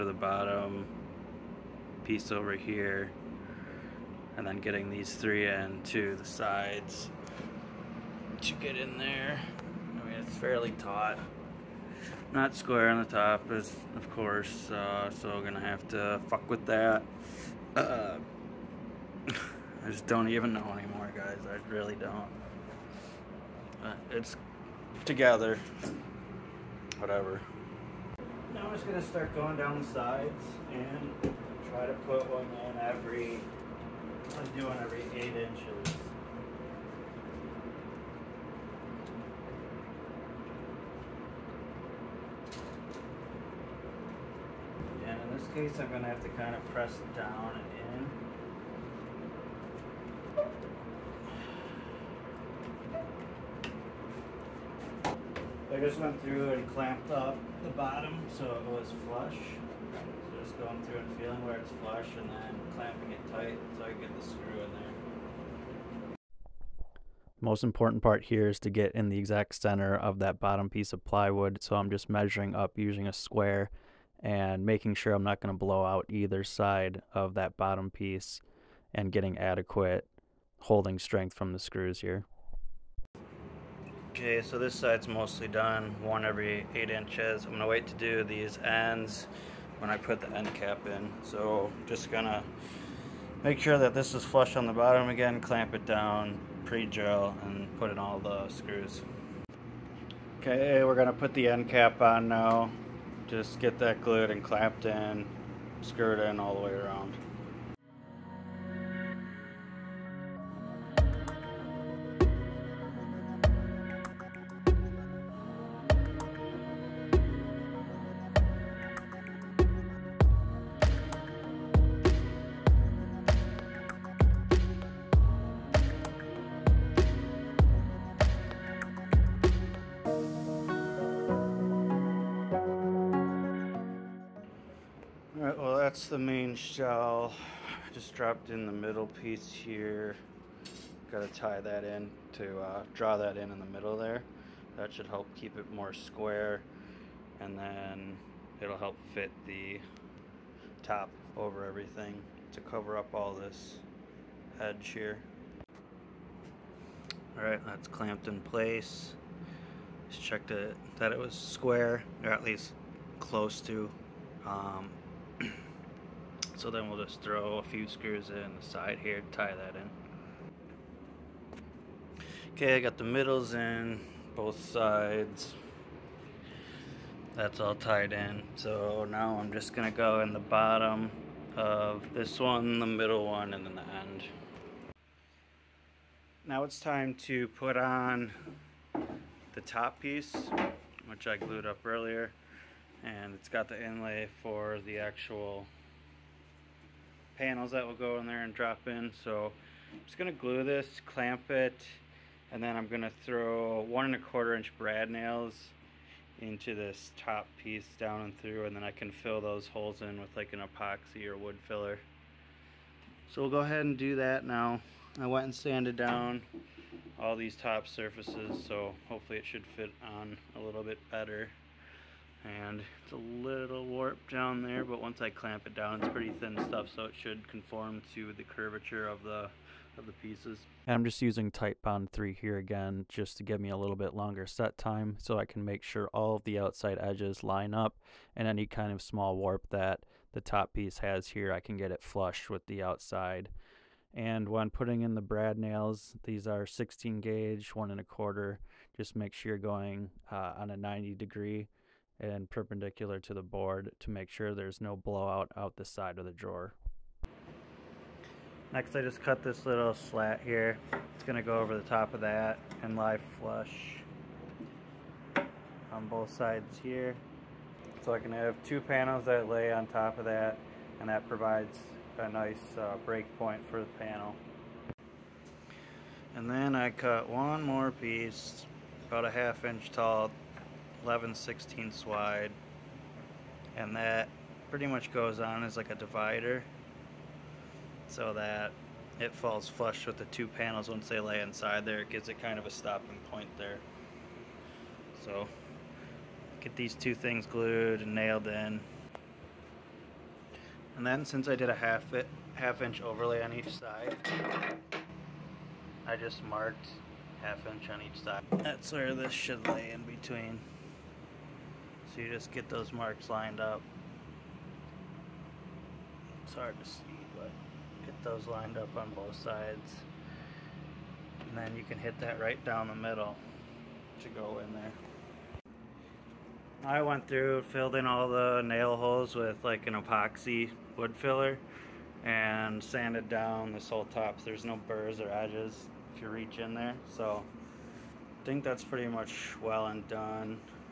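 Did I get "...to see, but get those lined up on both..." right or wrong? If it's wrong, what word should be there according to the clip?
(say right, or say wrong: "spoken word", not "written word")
right.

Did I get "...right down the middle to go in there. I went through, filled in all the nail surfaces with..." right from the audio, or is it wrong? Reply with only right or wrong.
wrong.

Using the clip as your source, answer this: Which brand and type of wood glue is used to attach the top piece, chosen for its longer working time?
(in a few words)
Titebond 3.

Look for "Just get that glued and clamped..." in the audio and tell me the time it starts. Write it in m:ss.
1:43.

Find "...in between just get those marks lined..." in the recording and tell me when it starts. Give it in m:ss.
5:09.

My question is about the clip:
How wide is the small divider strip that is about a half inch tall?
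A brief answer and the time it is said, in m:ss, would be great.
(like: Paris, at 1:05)
11/16, at 4:41.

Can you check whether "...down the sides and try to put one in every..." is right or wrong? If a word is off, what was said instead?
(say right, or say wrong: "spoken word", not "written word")
right.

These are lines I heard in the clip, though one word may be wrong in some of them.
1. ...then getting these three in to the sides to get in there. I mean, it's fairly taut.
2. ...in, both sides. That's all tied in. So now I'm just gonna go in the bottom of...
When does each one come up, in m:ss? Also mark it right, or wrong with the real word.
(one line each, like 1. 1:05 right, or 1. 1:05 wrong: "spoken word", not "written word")
1. 0:04 right
2. 2:53 right.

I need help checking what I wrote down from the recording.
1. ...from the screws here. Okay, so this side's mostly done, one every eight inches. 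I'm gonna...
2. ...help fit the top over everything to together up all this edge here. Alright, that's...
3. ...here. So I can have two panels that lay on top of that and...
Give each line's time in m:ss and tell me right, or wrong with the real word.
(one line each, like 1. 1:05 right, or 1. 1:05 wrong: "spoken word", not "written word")
1. 1:21 right
2. 2:28 wrong: "cover", not "together"
3. 4:26 right.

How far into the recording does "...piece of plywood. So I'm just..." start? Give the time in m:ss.
1:10.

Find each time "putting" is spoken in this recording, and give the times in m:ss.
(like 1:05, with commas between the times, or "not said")
4:04.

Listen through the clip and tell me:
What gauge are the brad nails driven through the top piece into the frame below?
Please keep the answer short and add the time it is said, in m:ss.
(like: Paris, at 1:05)
16 gauge, at 4:06.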